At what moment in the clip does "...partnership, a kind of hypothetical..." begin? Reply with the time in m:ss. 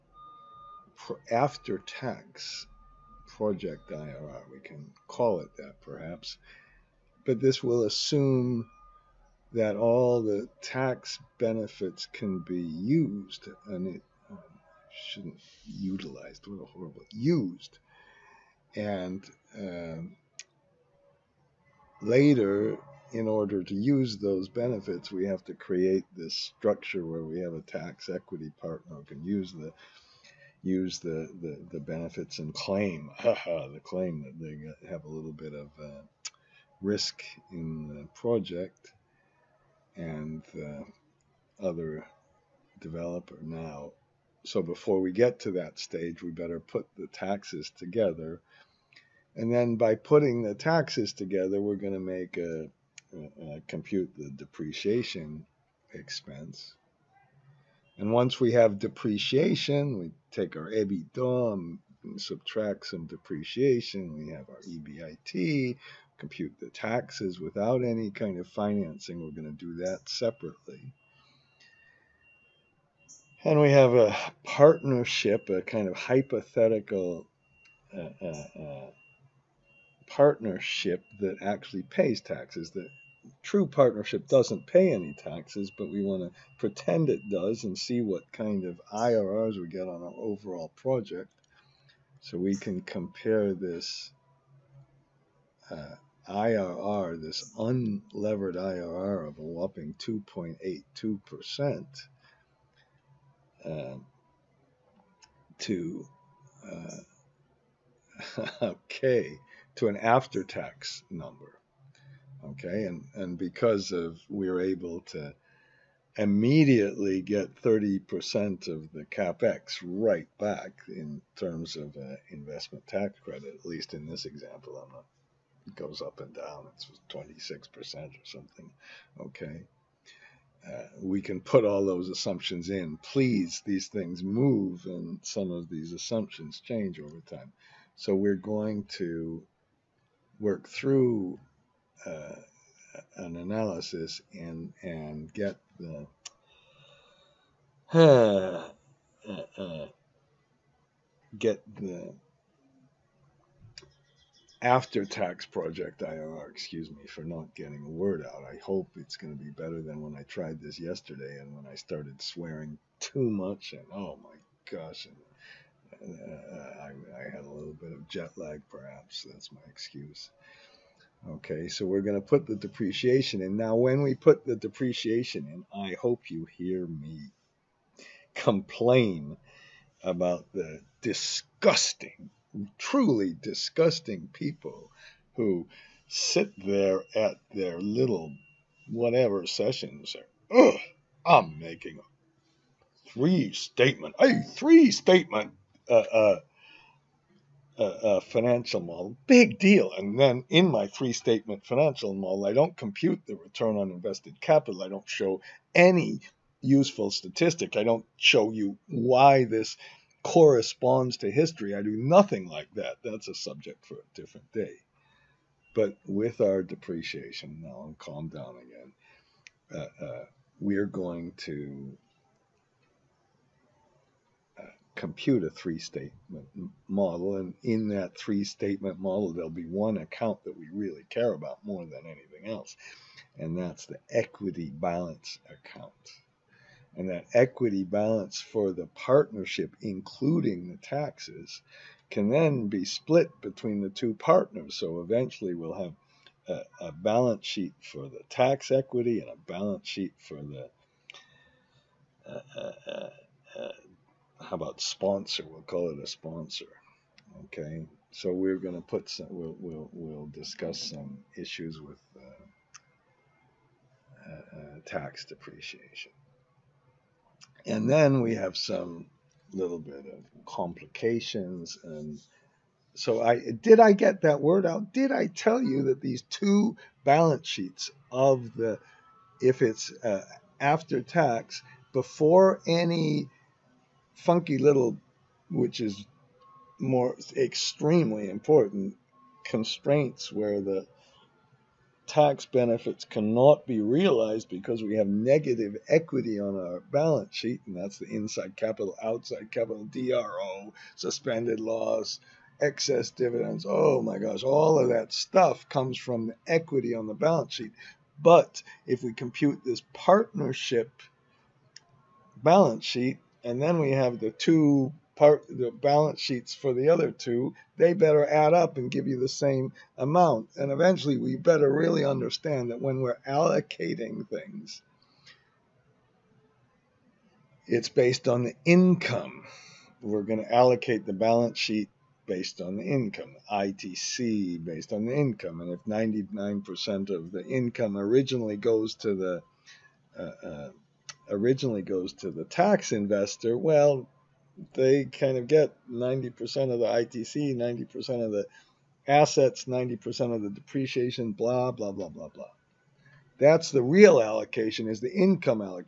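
1:14.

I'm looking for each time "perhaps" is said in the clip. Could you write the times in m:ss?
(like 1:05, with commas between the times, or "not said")
0:05, 2:48.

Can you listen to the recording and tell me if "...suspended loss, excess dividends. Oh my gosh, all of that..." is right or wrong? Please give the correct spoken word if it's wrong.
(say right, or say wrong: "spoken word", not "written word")
right.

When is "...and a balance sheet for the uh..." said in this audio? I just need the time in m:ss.
4:09.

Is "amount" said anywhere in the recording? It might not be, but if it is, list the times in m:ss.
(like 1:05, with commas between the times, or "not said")
5:19.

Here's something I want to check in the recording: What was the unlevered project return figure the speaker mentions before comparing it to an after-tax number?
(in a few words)
2.82%.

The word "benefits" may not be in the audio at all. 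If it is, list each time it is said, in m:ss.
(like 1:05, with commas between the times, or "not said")
0:11, 0:24, 0:31, 4:52.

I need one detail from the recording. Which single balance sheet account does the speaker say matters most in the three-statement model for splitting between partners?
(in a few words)
equity balance account.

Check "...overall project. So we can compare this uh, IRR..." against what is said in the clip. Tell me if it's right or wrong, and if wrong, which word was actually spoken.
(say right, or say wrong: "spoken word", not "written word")
right.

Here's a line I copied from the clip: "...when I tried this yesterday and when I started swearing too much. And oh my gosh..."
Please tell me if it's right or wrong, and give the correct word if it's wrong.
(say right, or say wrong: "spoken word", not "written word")
right.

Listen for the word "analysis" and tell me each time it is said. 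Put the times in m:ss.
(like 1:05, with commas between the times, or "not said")
2:23.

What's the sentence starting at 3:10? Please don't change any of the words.
Ugh, I'm making a three statement, a three statement uh, uh, uh, uh, financial model.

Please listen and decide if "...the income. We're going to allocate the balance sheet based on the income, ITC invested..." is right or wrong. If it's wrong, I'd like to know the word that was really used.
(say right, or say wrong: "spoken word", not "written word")
wrong: "based", not "invested".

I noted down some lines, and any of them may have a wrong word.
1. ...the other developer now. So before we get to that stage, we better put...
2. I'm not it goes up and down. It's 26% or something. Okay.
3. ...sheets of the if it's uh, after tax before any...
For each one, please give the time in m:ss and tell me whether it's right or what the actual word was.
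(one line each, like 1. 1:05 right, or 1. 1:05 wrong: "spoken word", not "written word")
1. 0:40 right
2. 2:04 right
3. 4:37 right.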